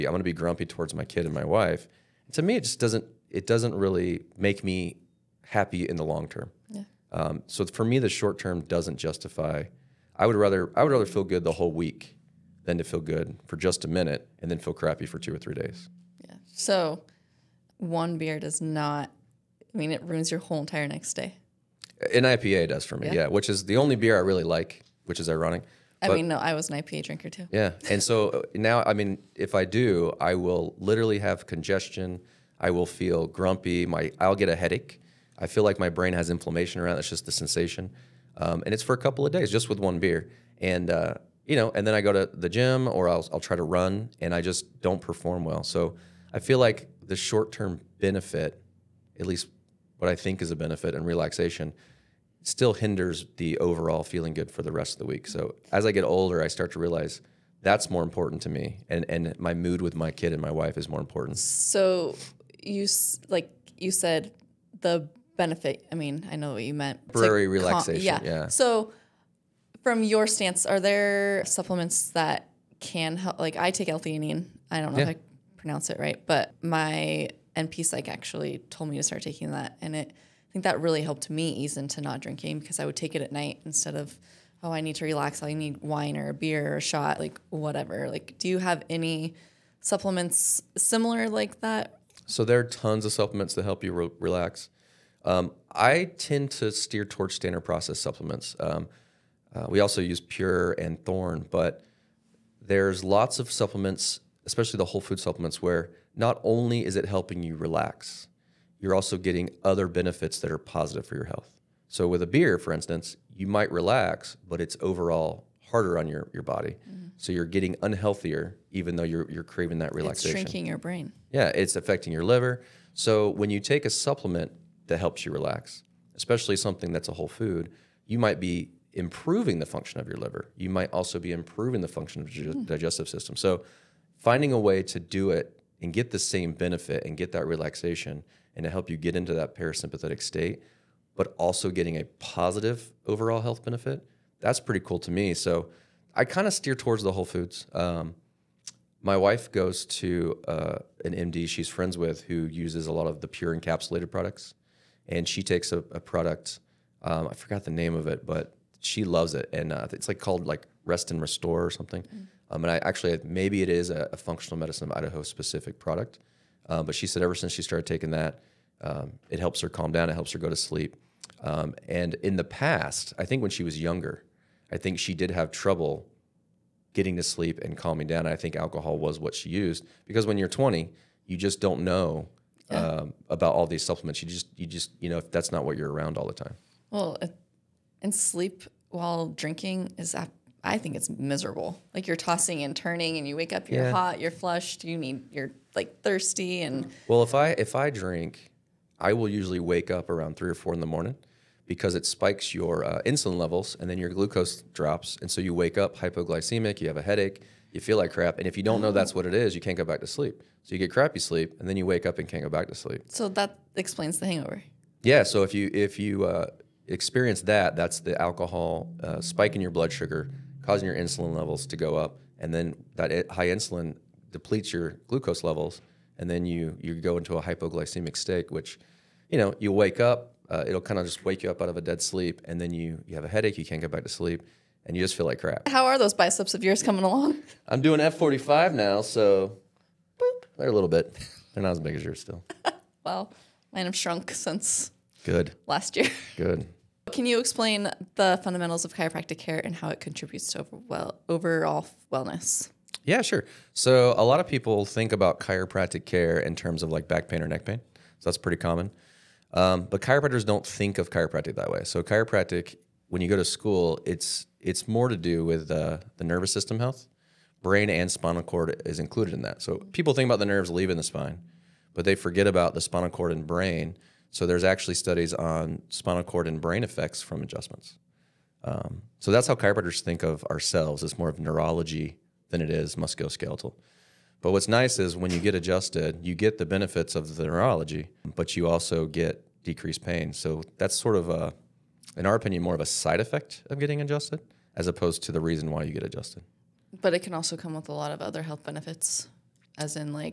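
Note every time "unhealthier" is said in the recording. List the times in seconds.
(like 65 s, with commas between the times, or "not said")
117 s.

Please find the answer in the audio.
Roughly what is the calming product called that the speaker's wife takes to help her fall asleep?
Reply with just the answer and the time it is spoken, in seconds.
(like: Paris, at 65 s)
Rest and Restore, at 160 s.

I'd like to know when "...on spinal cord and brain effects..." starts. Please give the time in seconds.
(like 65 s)
275 s.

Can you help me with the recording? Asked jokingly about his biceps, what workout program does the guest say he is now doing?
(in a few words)
F45.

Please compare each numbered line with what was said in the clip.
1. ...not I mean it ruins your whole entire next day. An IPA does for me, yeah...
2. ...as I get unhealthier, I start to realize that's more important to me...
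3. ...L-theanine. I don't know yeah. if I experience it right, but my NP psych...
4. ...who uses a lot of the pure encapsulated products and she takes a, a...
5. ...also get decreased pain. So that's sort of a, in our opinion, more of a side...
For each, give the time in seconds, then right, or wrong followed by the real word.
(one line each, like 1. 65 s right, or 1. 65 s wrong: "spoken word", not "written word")
1. 18 s right
2. 55 s wrong: "older", not "unhealthier"
3. 73 s wrong: "pronounce", not "experience"
4. 152 s right
5. 288 s right.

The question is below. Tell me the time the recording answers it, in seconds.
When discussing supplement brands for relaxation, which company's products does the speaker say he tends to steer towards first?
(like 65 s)
97 s.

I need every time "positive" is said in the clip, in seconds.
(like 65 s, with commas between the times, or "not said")
110 s, 142 s.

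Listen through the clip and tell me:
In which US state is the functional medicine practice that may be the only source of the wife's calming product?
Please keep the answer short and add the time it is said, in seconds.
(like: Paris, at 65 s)
Idaho, at 164 s.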